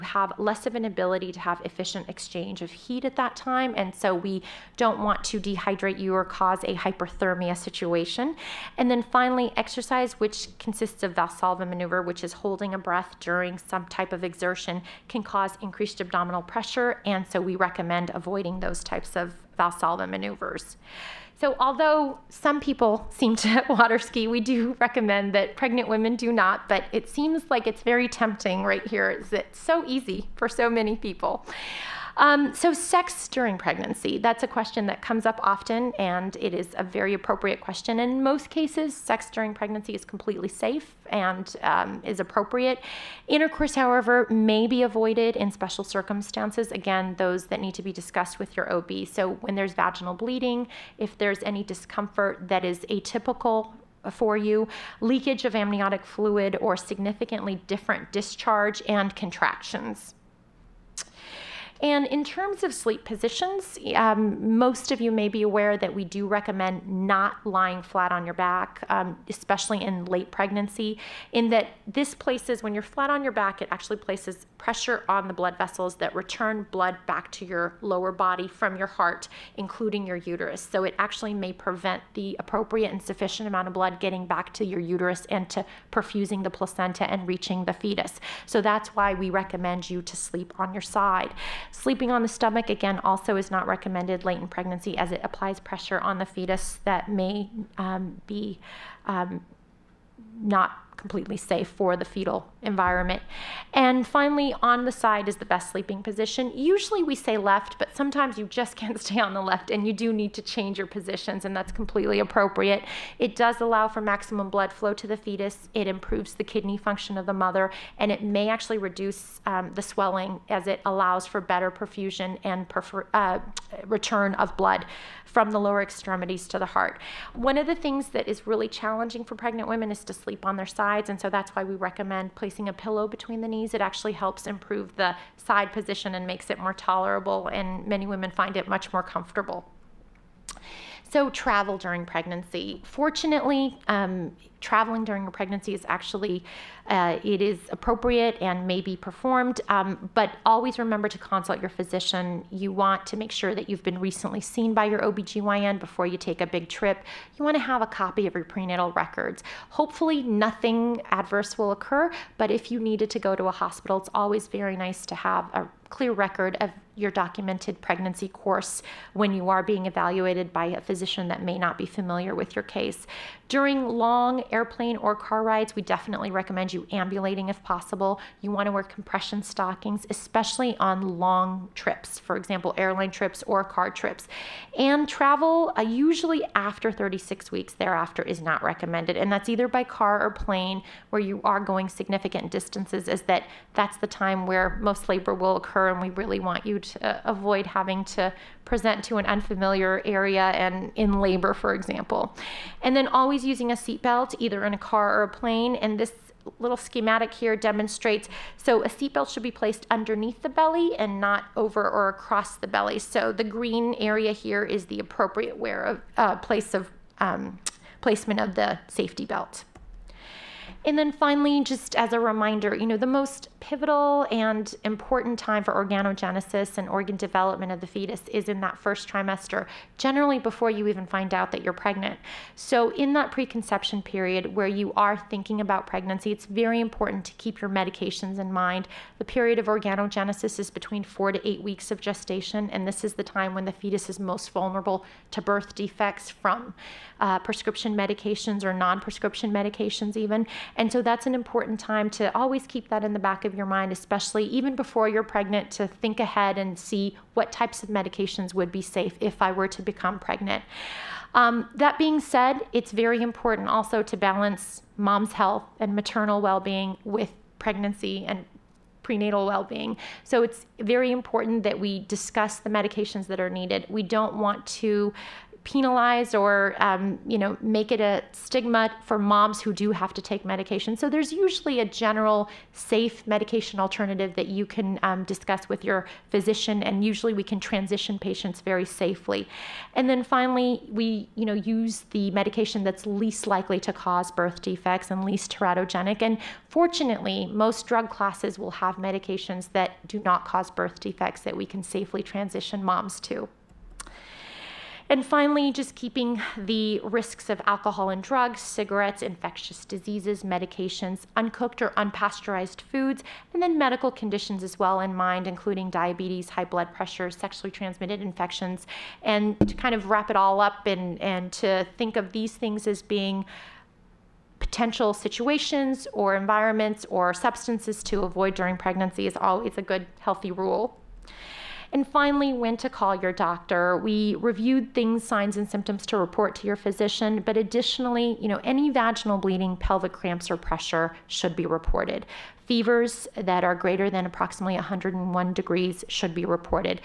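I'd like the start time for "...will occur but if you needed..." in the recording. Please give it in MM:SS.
02:41.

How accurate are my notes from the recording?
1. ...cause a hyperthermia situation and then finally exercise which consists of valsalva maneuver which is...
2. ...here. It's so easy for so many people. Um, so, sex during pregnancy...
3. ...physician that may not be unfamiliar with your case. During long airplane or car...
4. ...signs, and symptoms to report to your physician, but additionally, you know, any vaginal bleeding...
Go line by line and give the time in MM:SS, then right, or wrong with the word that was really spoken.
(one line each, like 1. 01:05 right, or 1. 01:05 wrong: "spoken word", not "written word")
1. 00:06 right
2. 00:28 right
3. 02:50 wrong: "familiar", not "unfamiliar"
4. 05:35 right.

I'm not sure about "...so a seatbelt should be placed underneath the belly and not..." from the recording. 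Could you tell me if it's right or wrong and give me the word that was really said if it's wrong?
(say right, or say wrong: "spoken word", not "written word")
right.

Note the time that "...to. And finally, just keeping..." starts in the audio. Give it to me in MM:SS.
05:03.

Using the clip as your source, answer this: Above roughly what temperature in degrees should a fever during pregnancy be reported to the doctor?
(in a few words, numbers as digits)
101.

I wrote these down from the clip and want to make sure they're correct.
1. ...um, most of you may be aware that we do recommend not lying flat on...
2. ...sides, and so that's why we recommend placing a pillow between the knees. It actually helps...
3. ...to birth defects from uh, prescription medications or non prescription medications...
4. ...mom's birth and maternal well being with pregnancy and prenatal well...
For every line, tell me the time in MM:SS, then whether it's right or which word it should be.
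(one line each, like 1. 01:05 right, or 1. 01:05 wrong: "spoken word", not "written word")
1. 01:03 right
2. 02:10 right
3. 04:05 right
4. 04:24 wrong: "health", not "birth".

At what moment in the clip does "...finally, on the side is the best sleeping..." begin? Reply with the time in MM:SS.
01:44.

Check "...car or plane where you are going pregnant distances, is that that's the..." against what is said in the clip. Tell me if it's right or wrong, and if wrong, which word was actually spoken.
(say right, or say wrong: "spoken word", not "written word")
wrong: "significant", not "pregnant".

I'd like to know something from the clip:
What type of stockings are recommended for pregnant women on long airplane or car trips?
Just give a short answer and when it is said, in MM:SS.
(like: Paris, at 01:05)
compression stockings, at 02:58.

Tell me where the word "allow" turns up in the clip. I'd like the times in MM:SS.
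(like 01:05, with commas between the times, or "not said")
01:53, 02:00.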